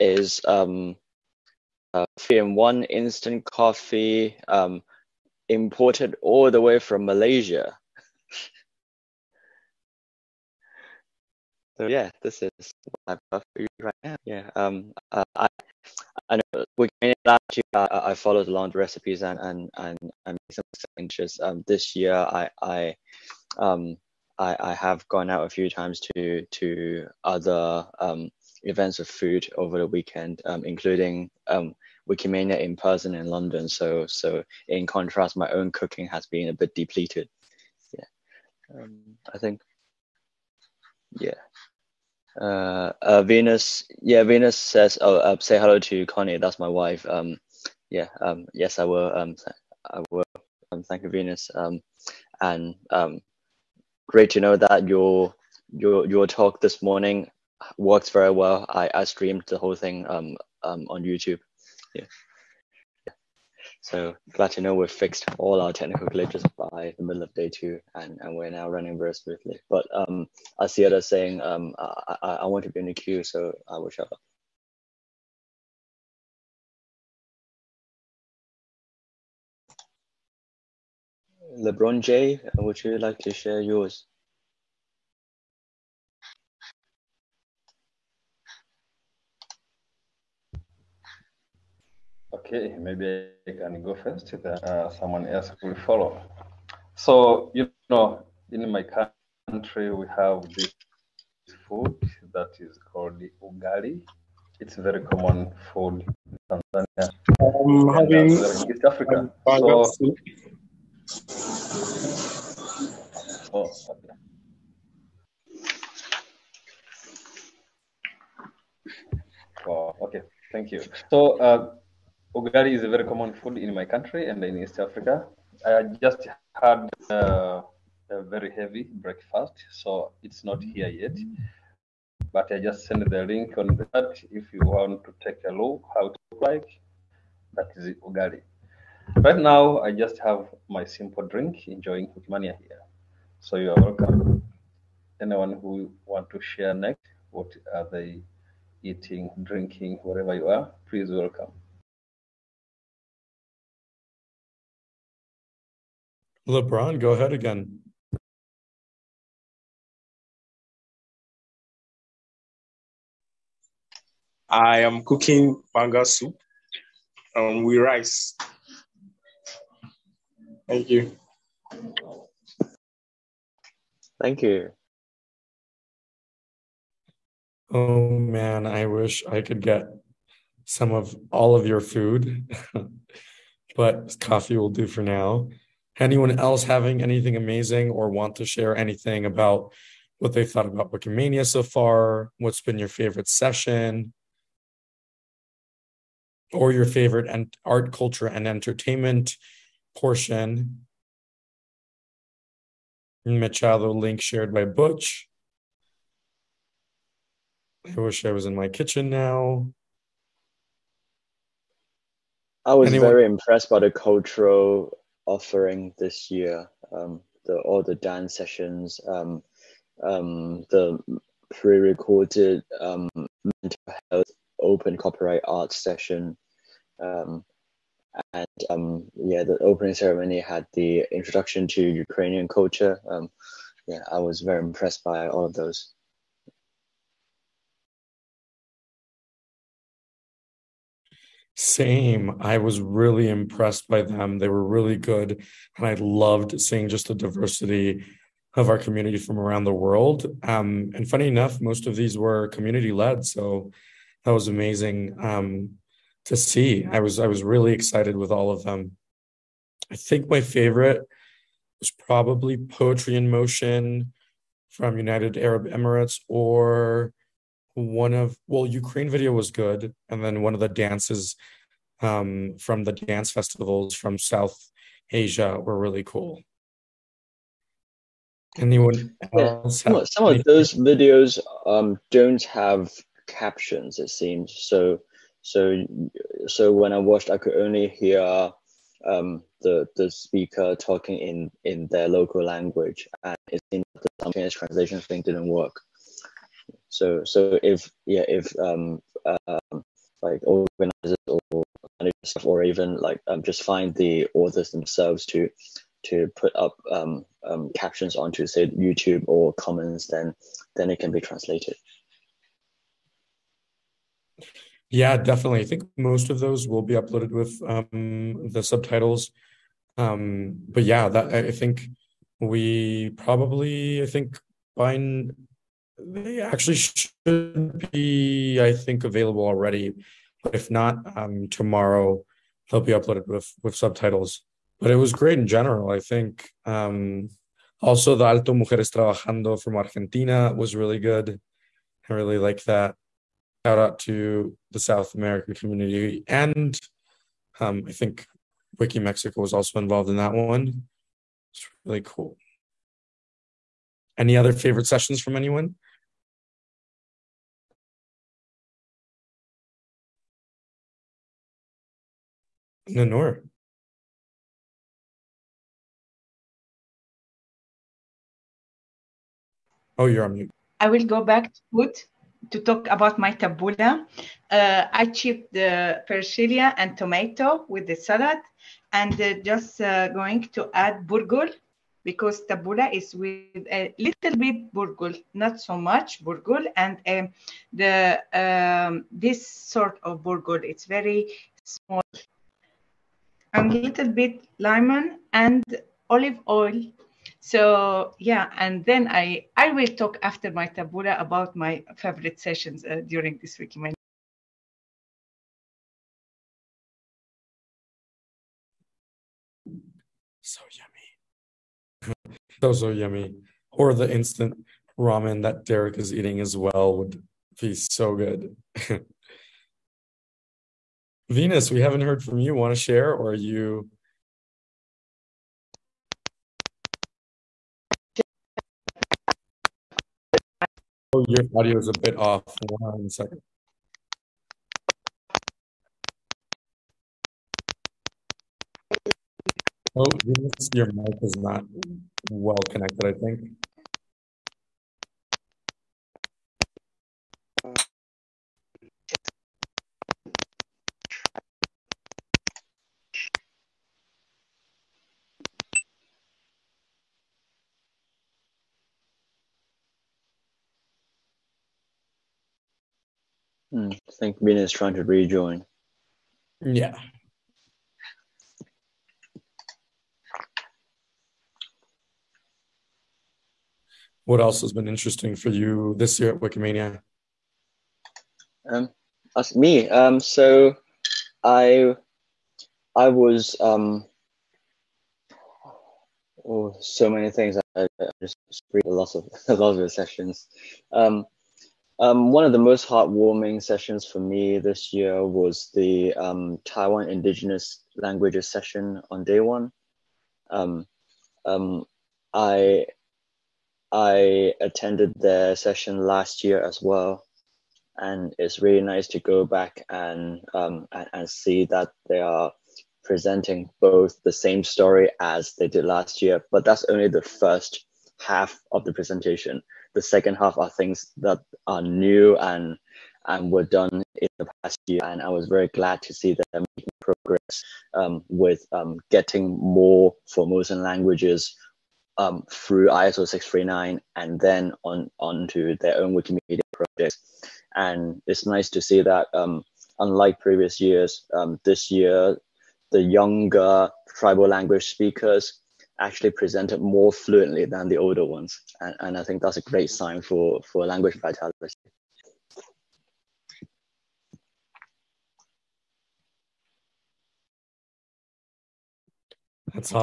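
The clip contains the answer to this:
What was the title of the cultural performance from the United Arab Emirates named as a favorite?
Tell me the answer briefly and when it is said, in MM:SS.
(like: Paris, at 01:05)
Poetry in Motion, at 04:22.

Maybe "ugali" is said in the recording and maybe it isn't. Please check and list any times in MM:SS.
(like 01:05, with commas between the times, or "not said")
01:43, 02:02, 02:18.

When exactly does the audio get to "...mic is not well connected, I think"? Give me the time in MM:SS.
07:20.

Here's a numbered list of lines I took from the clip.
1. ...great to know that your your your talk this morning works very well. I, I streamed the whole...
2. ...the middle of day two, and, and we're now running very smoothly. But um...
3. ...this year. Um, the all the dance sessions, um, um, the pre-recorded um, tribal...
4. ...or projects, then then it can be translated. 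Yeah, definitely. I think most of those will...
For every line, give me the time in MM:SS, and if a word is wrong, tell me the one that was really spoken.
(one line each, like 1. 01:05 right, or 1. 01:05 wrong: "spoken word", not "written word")
1. 00:54 right
2. 01:06 right
3. 03:35 wrong: "mental", not "tribal"
4. 05:09 wrong: "comments", not "projects".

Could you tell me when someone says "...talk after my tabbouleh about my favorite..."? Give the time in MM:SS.
06:39.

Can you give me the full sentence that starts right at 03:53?
Um, yeah, I was very impressed by all of those.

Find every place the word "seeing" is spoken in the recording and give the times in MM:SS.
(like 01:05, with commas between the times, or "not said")
04:06.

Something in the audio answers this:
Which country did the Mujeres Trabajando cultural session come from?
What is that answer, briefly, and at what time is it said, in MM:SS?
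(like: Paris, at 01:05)
Argentina, at 05:39.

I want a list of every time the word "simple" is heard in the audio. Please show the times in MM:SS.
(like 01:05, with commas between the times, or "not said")
02:20.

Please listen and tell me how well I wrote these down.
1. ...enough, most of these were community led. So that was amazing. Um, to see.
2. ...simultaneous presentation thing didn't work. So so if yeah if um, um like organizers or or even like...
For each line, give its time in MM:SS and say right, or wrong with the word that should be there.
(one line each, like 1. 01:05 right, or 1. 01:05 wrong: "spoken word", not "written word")
1. 04:11 right
2. 04:54 wrong: "translation", not "presentation".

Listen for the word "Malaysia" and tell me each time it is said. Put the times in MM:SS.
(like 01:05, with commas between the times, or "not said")
00:07.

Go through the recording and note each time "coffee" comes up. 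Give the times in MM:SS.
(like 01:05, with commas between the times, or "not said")
00:03, 03:04.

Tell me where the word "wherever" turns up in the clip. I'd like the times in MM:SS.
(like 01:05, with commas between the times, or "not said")
02:30.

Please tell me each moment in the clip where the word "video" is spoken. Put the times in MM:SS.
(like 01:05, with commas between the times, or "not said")
04:29, 04:40.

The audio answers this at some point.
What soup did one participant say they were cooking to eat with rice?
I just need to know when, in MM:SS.
02:45.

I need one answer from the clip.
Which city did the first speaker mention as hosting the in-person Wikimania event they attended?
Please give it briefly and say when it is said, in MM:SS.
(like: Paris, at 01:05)
London, at 00:33.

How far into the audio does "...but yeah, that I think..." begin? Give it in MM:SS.
05:20.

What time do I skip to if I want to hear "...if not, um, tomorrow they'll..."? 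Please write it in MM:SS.
05:30.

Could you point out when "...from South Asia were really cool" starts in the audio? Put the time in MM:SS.
04:33.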